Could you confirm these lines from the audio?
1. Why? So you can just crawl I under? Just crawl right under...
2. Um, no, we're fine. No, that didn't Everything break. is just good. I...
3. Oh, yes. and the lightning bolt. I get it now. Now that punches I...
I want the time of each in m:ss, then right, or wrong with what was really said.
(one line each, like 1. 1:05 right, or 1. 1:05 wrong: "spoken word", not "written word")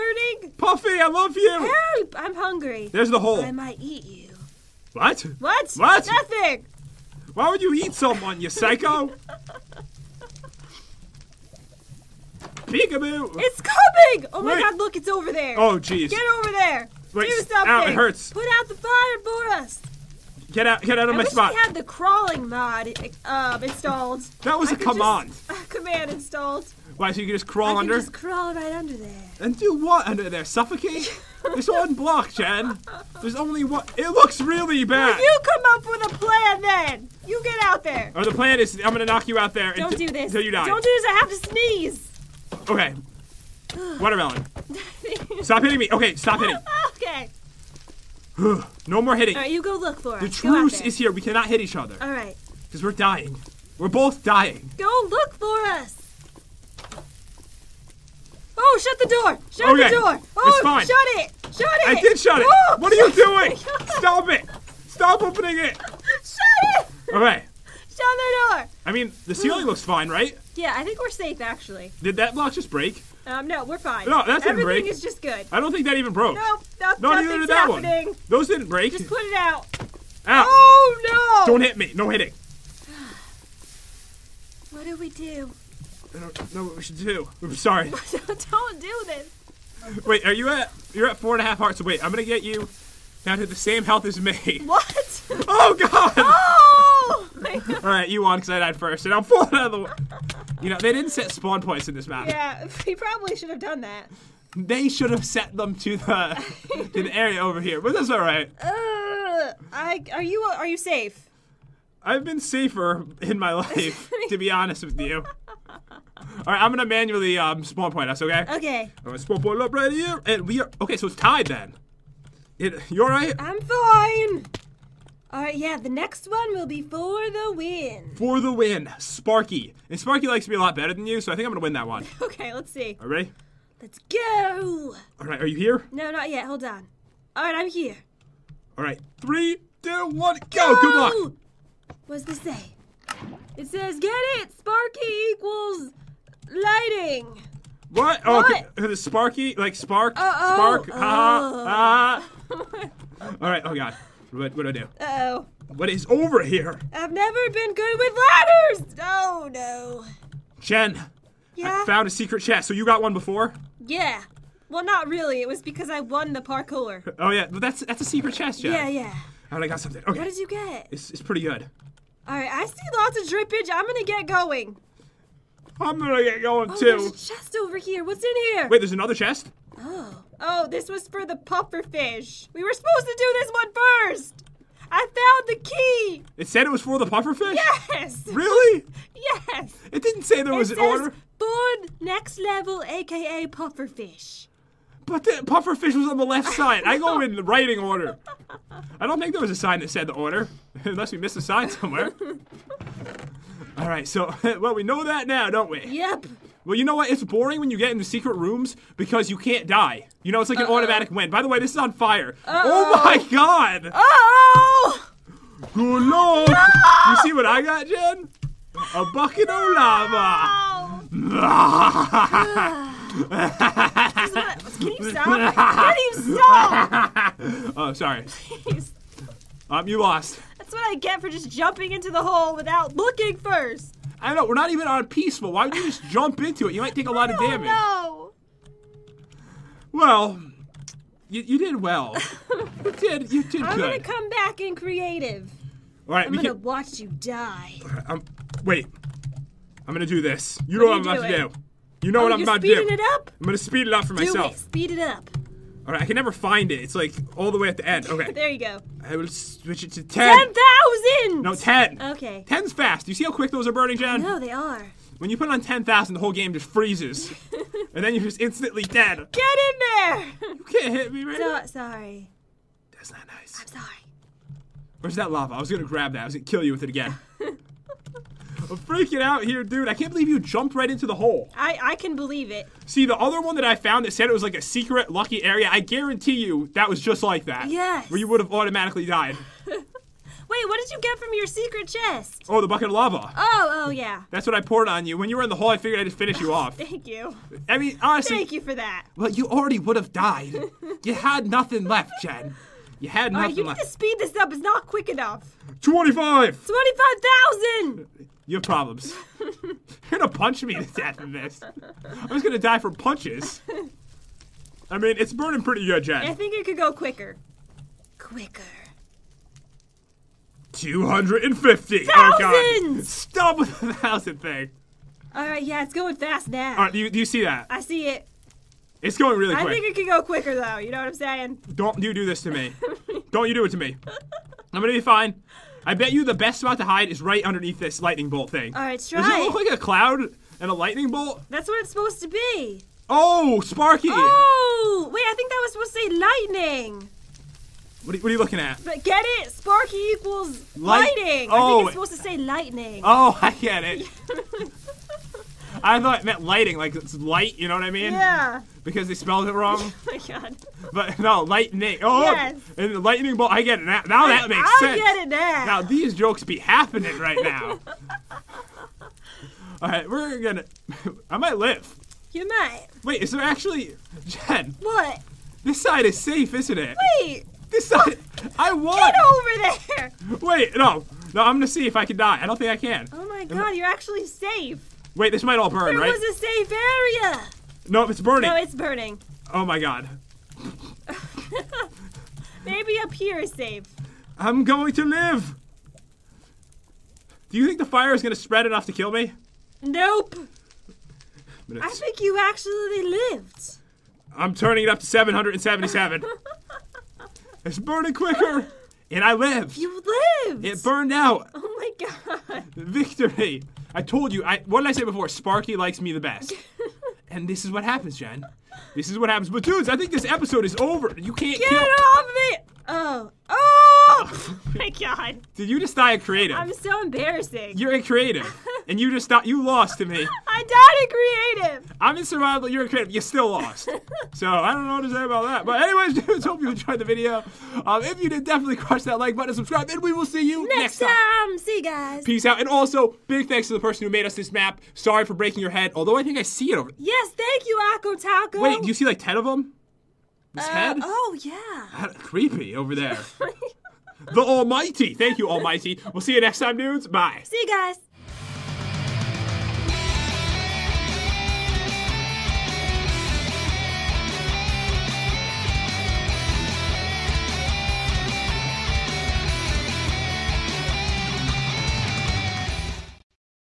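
1. 0:26 right
2. 1:13 right
3. 6:02 wrong: "makes", not "punches".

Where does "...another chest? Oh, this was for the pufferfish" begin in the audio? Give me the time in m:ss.
2:58.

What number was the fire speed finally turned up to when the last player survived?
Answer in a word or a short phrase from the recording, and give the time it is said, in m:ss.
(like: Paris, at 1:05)
777, at 6:45.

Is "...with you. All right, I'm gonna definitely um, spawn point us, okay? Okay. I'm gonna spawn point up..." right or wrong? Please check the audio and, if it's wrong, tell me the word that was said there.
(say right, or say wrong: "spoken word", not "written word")
wrong: "manually", not "definitely".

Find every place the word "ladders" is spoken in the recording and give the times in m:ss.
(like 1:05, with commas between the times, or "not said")
2:38.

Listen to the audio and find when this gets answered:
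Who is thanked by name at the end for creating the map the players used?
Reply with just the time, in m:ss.
7:27.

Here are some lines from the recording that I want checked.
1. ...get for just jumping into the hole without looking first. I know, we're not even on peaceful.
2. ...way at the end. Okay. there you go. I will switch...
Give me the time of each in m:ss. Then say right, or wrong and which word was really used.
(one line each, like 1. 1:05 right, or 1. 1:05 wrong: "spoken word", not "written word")
1. 3:50 right
2. 4:17 right.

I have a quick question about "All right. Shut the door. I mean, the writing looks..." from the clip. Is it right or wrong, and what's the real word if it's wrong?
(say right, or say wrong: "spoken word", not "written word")
wrong: "ceiling", not "writing".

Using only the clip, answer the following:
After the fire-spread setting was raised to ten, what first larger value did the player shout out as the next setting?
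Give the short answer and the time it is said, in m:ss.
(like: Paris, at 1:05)
25,000, at 5:05.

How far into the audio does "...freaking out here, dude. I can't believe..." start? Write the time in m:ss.
4:38.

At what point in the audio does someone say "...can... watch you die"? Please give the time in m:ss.
4:06.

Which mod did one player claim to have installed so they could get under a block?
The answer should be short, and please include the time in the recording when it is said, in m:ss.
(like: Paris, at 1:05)
Crawling mod, at 0:21.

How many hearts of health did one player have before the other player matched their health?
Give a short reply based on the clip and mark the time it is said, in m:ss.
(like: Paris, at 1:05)
4.5, at 1:31.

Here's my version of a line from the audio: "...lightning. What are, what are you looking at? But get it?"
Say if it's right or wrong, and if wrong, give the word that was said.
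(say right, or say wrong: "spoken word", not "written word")
right.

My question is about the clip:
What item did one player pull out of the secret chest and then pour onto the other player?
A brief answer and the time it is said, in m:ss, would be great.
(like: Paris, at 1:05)
Bucket of lava, at 3:38.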